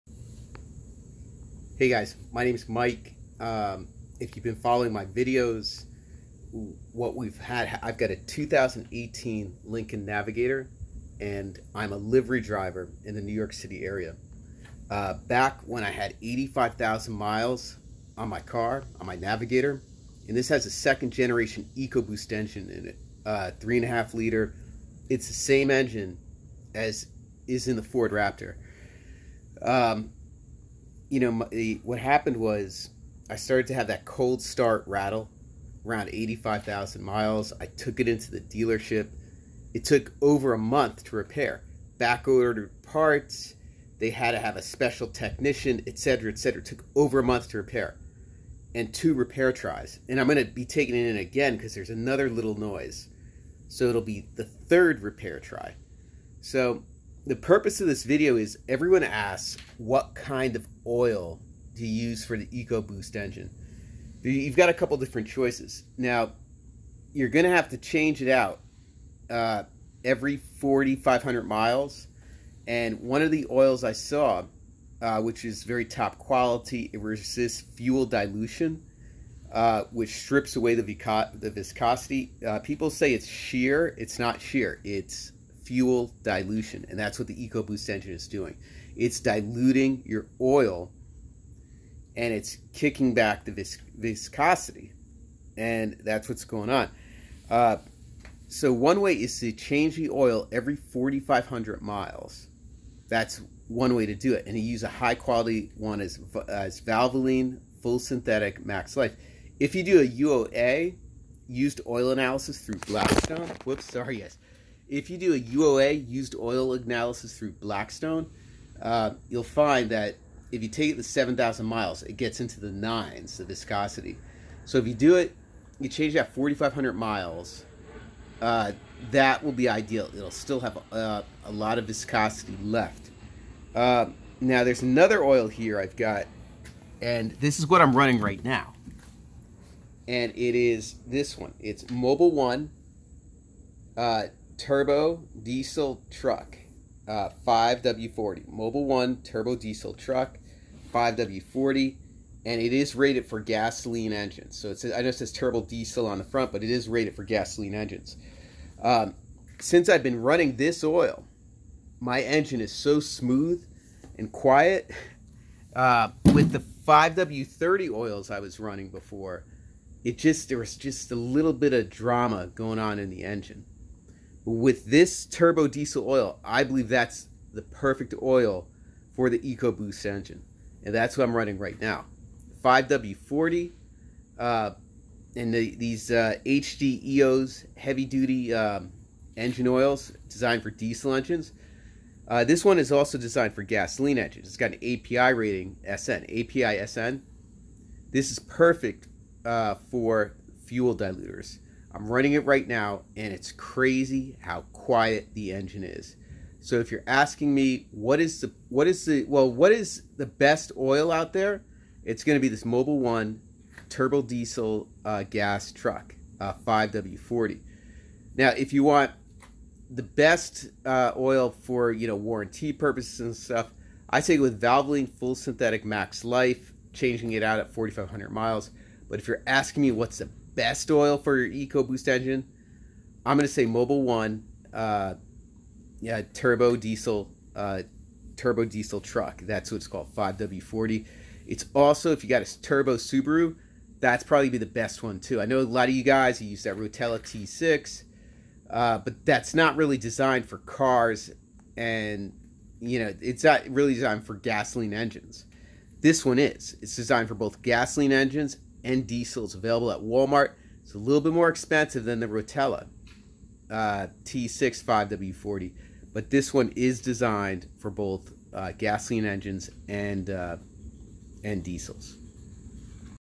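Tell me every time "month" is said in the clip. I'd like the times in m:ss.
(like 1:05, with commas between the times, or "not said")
0:40, 0:47.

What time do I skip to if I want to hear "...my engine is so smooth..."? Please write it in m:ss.
2:41.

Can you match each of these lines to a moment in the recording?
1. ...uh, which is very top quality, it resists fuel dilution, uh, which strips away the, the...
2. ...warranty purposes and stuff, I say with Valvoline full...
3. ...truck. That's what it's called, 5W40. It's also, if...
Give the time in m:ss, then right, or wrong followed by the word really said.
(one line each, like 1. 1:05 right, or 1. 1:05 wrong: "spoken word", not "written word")
1. 1:15 right
2. 3:42 right
3. 3:59 right.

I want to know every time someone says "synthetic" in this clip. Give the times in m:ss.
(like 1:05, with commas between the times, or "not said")
1:47, 3:45.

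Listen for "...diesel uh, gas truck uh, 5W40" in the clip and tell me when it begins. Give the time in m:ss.
3:34.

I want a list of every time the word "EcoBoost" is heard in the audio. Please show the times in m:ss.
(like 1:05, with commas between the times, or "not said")
0:21, 1:02, 1:27, 2:59, 3:51.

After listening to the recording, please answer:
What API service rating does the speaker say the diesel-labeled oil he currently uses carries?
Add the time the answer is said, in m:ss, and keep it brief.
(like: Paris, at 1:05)
API SN, at 3:16.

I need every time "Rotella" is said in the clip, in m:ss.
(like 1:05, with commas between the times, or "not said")
4:06, 4:22.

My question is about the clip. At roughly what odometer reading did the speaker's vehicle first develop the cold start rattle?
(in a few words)
85,000 miles.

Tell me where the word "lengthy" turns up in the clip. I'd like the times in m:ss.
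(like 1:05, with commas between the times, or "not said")
not said.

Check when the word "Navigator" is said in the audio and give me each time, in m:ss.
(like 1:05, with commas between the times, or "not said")
0:10, 0:19.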